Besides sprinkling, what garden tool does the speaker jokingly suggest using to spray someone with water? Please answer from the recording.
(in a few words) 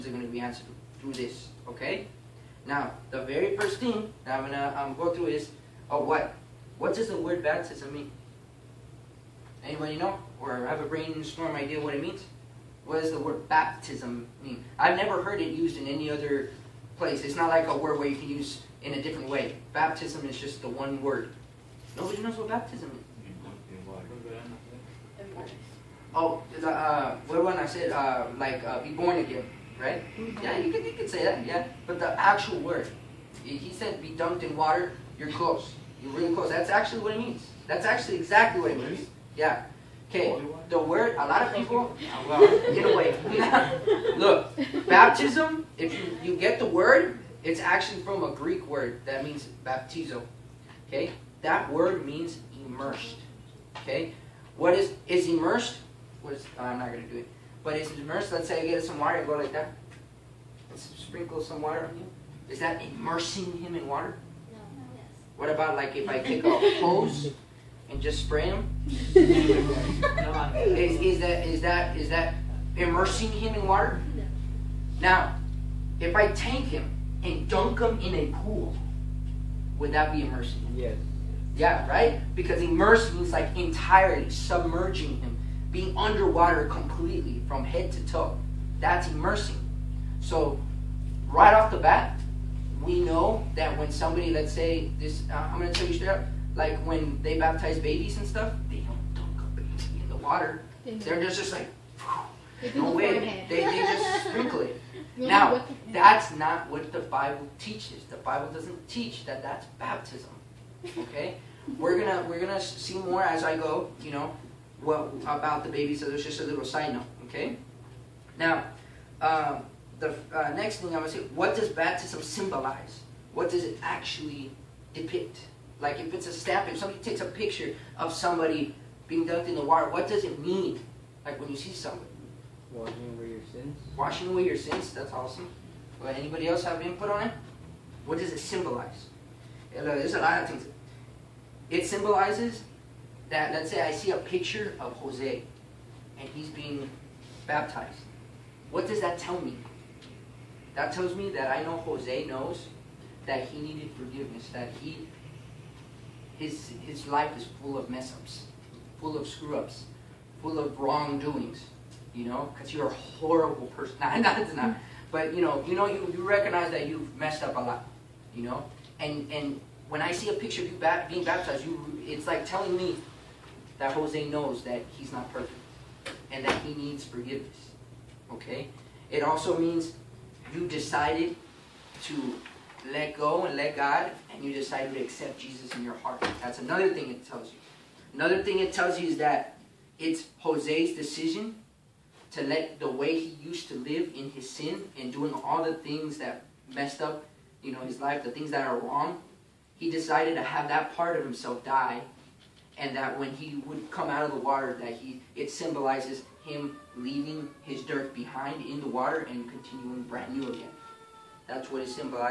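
a hose.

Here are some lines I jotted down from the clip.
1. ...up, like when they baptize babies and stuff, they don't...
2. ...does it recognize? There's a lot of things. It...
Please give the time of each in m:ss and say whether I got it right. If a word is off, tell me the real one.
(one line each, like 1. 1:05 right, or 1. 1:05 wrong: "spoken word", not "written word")
1. 1:36 right
2. 2:18 wrong: "symbolize", not "recognize".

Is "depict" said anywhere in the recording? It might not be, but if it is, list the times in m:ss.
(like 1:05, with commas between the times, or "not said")
2:04.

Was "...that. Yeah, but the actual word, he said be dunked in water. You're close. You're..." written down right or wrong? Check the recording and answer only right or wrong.
right.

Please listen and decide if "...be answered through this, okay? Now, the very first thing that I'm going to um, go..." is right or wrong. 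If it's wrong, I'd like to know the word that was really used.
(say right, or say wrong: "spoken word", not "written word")
right.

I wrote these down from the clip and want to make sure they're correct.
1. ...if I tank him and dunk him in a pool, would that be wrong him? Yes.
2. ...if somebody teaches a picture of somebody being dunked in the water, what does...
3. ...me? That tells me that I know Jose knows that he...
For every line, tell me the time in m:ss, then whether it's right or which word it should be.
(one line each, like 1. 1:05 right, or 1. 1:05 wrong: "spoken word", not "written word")
1. 1:15 wrong: "immersing", not "wrong"
2. 2:06 wrong: "takes", not "teaches"
3. 2:29 right.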